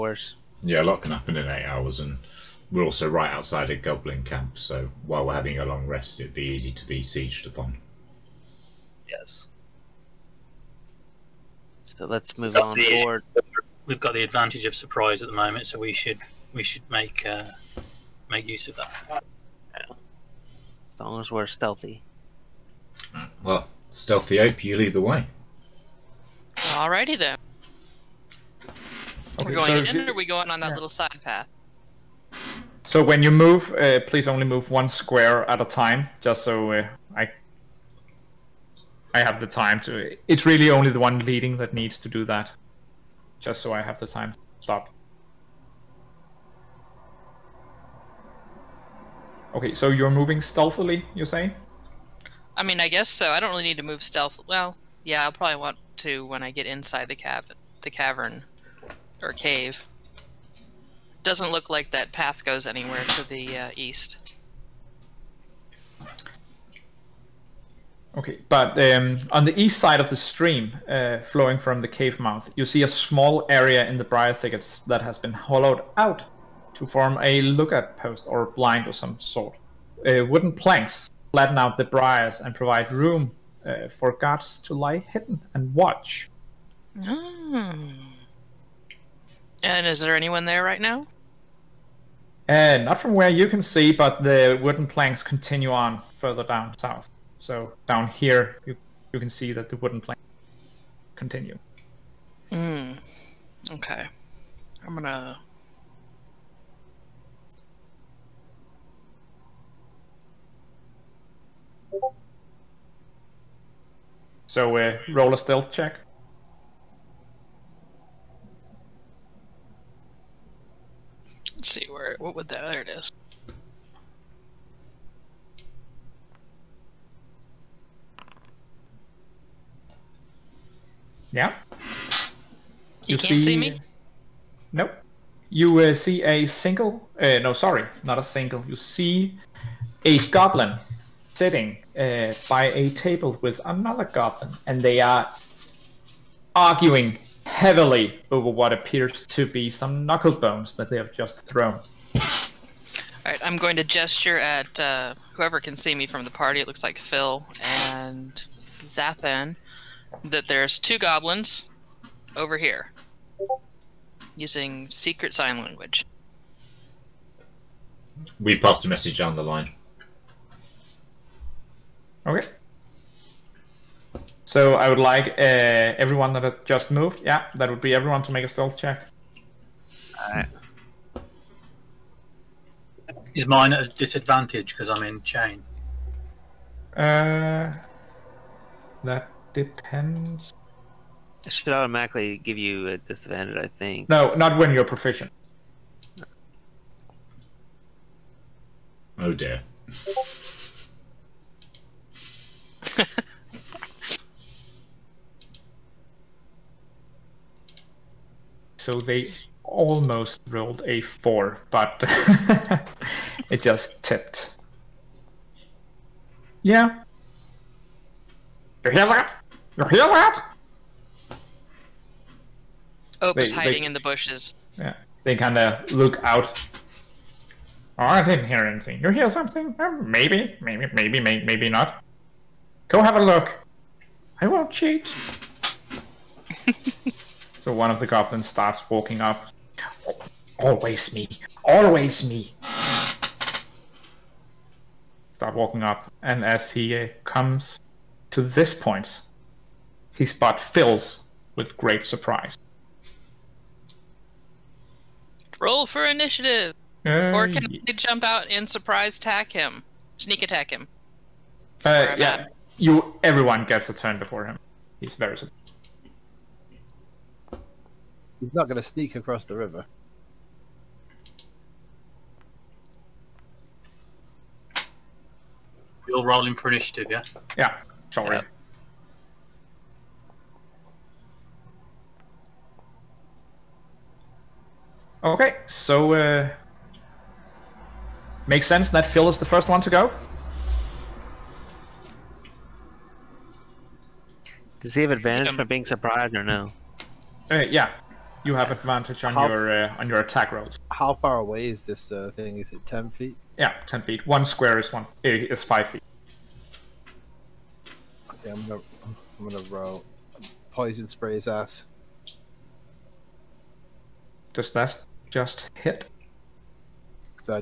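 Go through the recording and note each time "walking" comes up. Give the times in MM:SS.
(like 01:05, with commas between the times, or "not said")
03:58, 04:05.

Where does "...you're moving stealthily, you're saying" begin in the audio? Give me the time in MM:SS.
00:49.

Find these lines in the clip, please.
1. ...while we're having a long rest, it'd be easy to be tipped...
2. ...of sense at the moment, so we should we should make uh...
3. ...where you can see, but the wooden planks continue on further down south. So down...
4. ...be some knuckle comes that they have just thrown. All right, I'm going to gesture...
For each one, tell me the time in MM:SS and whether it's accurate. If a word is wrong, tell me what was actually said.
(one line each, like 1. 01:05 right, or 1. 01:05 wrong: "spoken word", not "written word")
1. 00:05 wrong: "sieged", not "tipped"
2. 00:14 wrong: "surprise", not "sense"
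3. 01:33 right
4. 02:29 wrong: "bones", not "comes".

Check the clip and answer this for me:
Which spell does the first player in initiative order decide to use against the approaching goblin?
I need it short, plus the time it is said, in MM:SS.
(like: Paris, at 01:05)
poison spray, at 05:10.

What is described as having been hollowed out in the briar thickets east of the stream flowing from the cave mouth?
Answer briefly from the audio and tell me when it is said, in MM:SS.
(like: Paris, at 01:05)
a lookout post, at 01:17.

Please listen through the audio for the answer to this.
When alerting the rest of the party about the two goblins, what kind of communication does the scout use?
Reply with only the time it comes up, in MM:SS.
02:44.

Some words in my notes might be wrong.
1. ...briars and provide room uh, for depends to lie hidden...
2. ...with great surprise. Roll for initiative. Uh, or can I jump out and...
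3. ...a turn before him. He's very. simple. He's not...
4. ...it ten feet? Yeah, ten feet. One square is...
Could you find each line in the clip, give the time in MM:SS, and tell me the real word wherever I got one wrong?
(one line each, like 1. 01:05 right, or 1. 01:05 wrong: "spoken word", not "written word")
1. 01:21 wrong: "guards", not "depends"
2. 04:11 right
3. 04:23 right
4. 05:02 right.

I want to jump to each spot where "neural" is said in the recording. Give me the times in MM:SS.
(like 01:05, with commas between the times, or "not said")
not said.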